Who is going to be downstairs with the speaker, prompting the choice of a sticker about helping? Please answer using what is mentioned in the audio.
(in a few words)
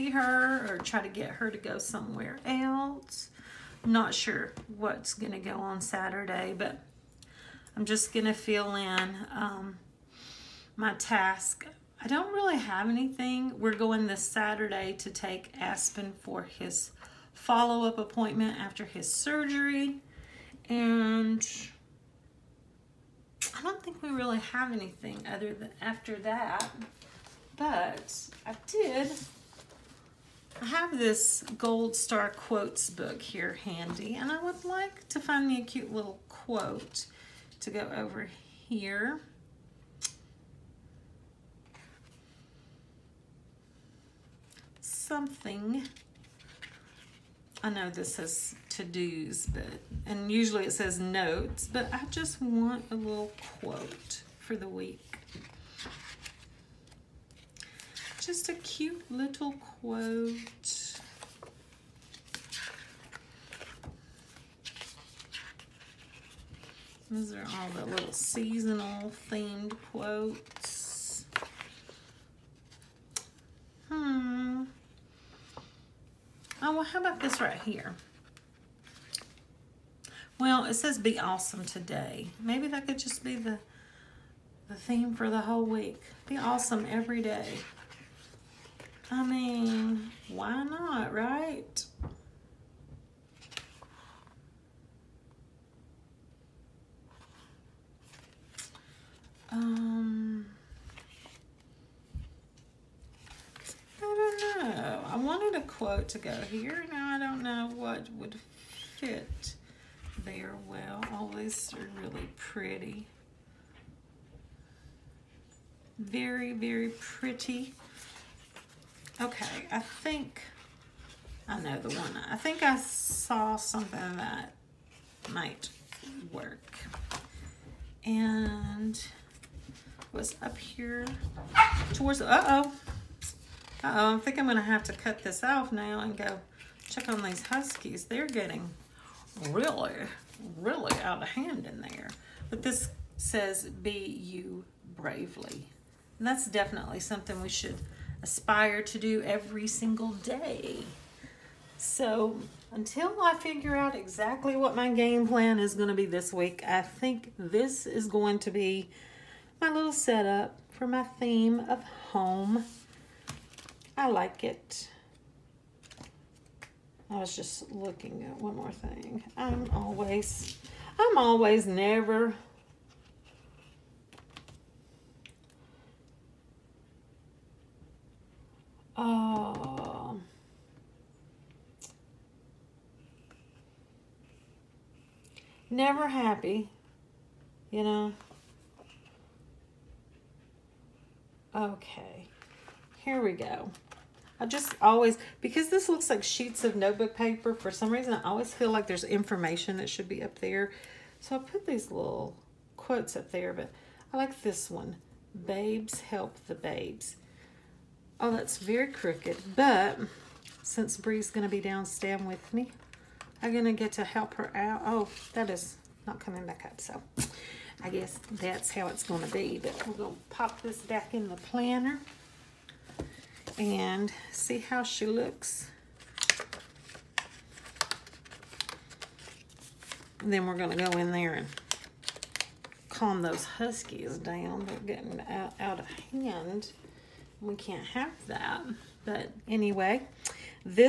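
Bree.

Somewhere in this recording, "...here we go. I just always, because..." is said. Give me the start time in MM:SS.
03:13.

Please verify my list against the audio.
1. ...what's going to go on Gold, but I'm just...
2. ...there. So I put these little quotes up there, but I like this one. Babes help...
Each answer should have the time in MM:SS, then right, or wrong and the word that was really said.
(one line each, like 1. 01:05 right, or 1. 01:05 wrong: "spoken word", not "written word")
1. 00:04 wrong: "Saturday", not "Gold"
2. 03:20 right.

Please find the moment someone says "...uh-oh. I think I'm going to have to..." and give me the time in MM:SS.
02:12.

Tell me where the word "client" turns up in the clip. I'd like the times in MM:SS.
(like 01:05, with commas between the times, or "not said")
not said.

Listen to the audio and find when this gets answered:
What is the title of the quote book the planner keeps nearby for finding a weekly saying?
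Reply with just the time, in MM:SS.
00:31.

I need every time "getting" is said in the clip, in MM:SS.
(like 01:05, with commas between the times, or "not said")
02:18, 03:54.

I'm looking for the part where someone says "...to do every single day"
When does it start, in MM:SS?
02:28.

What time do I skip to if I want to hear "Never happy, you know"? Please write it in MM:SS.
03:05.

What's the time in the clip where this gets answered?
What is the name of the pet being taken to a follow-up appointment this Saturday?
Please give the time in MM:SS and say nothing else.
00:15.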